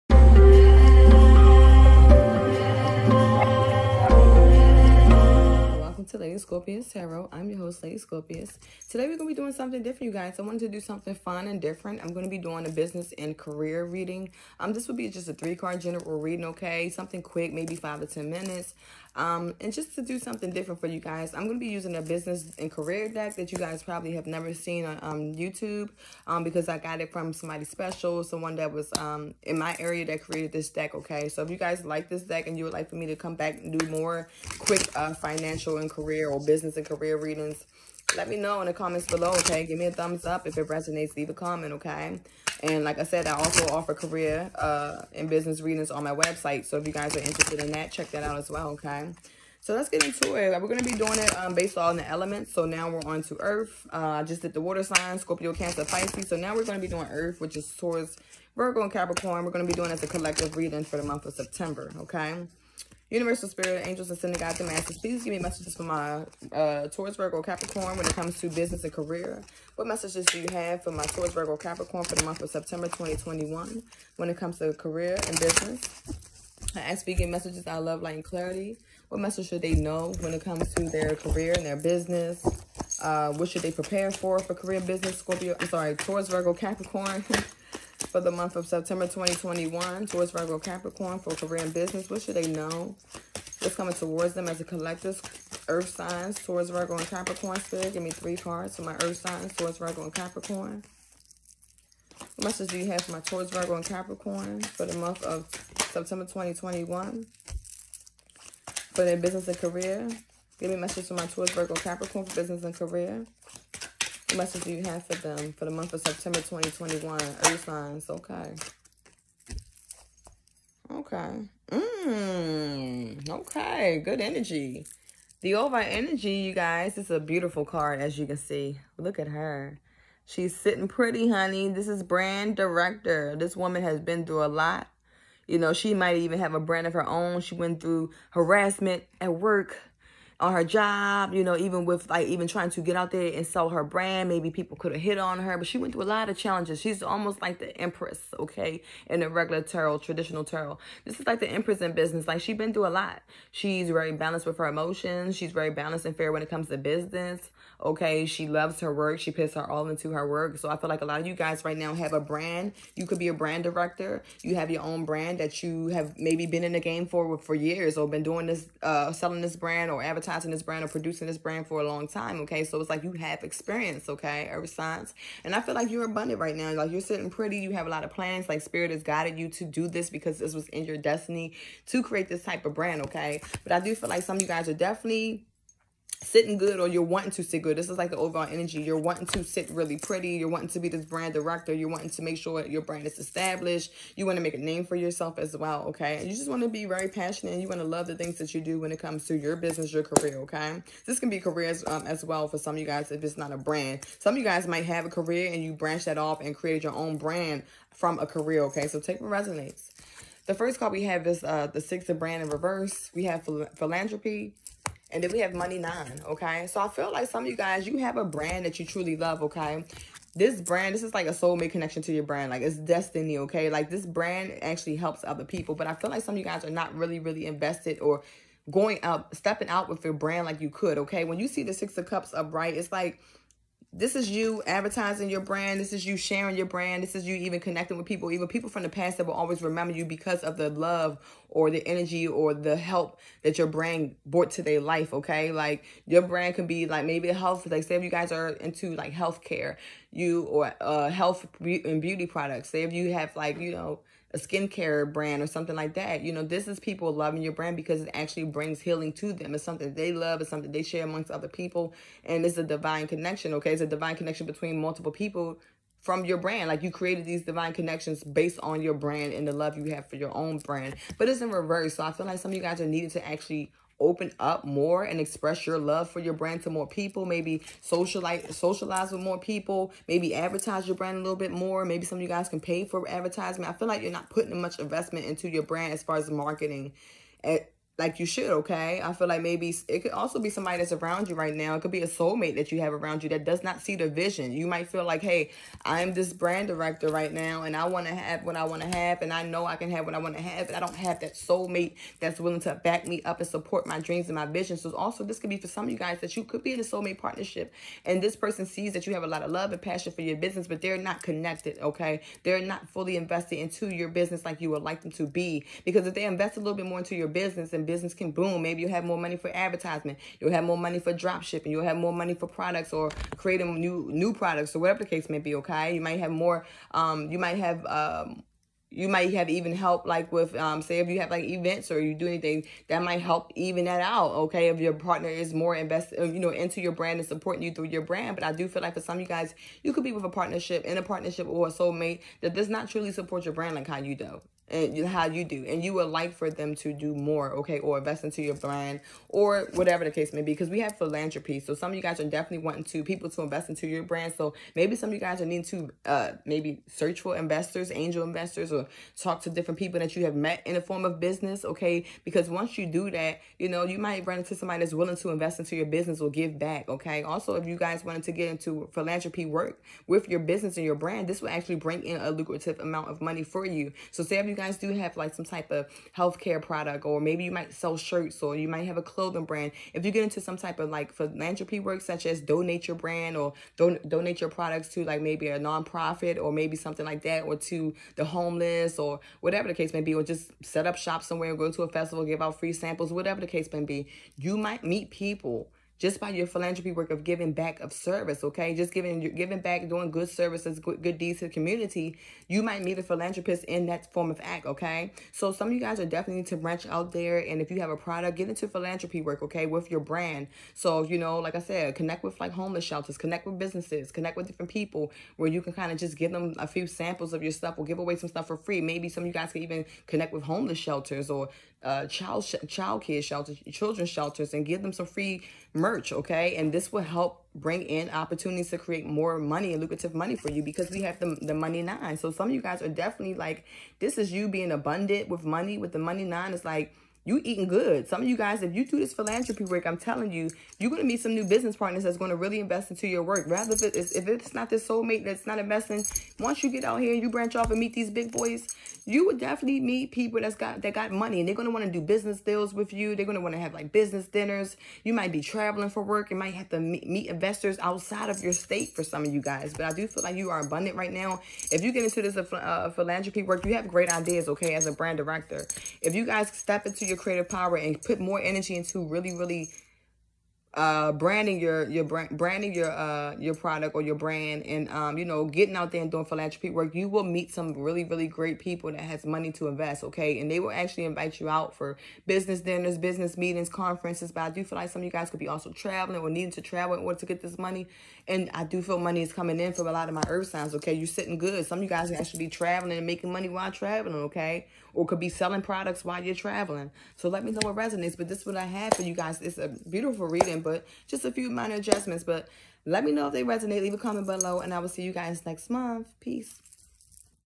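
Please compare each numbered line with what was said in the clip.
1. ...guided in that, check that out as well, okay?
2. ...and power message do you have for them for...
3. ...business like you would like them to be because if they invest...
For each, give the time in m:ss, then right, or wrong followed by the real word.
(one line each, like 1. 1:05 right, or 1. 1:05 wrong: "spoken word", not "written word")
1. 0:47 wrong: "interested", not "guided"
2. 1:52 wrong: "career", not "power"
3. 5:14 right.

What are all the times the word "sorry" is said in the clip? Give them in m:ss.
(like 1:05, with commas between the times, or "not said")
1:25.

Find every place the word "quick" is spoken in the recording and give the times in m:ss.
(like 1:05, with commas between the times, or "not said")
0:17, 0:34.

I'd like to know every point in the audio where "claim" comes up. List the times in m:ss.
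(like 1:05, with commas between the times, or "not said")
not said.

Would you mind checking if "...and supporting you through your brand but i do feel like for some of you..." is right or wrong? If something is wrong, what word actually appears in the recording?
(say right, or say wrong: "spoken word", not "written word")
right.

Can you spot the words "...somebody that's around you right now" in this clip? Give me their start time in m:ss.
4:50.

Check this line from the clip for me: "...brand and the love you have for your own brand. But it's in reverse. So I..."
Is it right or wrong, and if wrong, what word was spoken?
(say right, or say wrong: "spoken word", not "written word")
right.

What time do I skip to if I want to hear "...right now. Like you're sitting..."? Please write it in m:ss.
2:56.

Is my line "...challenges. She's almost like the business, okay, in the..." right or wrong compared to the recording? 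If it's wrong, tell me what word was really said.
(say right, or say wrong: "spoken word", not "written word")
wrong: "empress", not "business".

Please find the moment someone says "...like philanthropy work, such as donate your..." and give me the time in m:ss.
6:20.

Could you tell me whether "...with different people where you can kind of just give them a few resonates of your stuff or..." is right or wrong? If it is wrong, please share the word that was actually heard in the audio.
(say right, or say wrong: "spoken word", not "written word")
wrong: "samples", not "resonates".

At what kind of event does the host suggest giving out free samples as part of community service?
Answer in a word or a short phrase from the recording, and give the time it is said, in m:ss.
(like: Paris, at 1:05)
A festival, at 6:31.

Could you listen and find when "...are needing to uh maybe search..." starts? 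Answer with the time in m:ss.
5:55.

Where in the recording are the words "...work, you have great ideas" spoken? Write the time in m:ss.
7:43.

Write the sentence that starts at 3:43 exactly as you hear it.
Like, this brand actually helps other people.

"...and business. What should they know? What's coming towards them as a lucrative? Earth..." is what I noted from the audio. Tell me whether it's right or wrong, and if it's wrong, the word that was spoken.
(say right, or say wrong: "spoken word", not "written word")
wrong: "collective", not "lucrative".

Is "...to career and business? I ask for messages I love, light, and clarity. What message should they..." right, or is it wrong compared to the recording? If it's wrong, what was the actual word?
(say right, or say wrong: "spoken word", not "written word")
right.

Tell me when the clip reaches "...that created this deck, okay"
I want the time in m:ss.
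0:30.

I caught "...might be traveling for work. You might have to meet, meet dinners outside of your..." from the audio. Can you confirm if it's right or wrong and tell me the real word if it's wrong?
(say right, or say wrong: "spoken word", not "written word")
wrong: "investors", not "dinners".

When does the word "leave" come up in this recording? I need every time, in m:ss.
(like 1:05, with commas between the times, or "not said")
0:41, 8:23.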